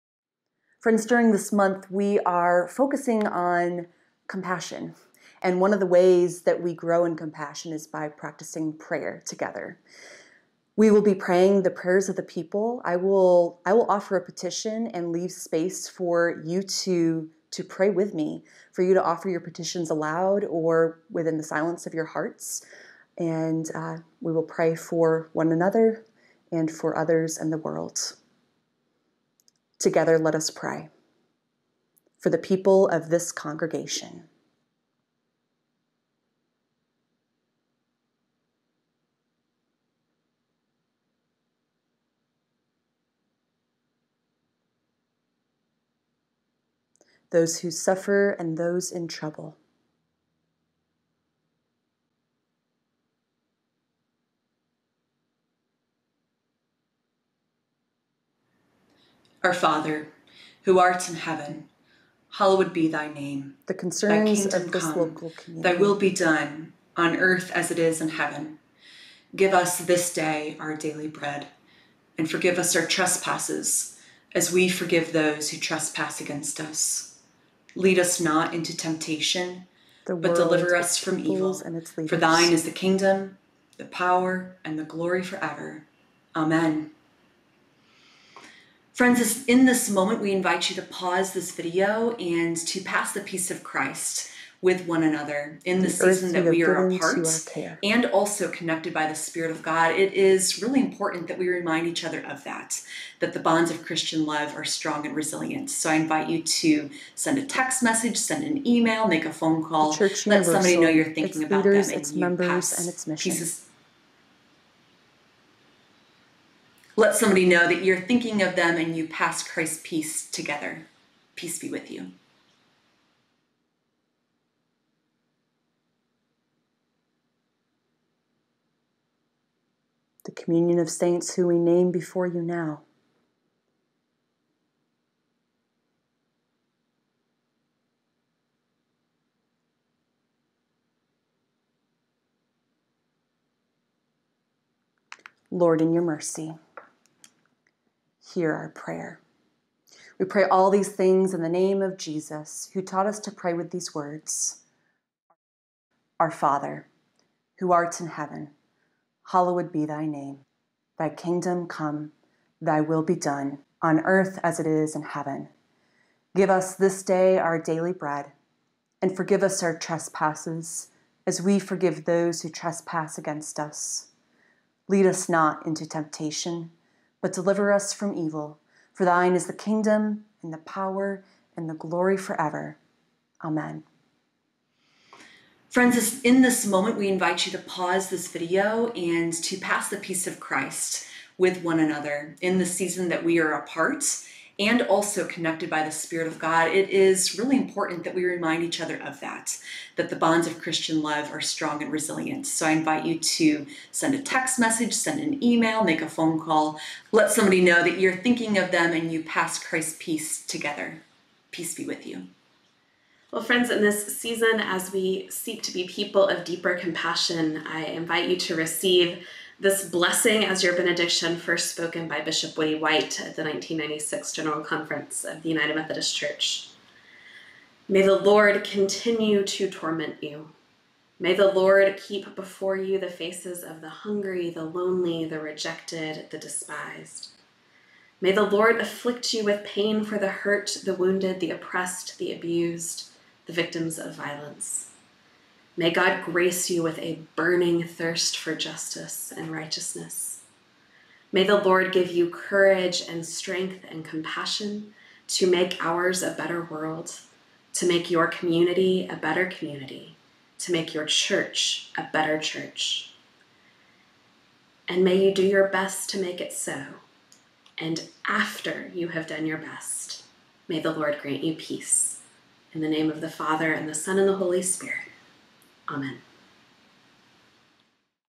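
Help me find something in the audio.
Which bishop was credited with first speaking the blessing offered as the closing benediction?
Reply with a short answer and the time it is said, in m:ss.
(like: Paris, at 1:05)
Bishop Woodie White, at 3:42.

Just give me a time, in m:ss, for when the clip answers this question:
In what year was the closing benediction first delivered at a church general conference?
3:43.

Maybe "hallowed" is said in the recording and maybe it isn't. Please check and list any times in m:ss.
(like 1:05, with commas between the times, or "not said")
1:02, 2:39.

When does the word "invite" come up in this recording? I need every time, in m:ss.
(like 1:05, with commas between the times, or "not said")
1:30, 1:45, 3:07, 3:22, 3:37.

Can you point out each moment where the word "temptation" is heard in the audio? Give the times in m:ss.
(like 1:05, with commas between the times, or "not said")
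1:18, 2:55.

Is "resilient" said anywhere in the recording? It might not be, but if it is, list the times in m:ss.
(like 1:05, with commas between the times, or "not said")
1:45, 3:21.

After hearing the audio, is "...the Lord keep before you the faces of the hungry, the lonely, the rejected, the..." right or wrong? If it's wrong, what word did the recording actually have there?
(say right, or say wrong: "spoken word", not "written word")
right.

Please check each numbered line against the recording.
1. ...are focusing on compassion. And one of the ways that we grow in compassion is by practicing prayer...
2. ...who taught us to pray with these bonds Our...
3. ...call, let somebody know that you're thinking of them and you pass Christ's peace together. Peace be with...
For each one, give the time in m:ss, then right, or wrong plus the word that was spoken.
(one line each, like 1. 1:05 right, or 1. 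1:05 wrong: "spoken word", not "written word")
1. 0:02 right
2. 2:32 wrong: "words", not "bonds"
3. 3:26 right.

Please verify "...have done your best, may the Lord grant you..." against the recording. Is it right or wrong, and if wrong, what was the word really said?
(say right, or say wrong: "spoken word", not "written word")
right.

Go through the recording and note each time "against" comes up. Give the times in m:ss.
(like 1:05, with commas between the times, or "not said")
1:16, 2:53.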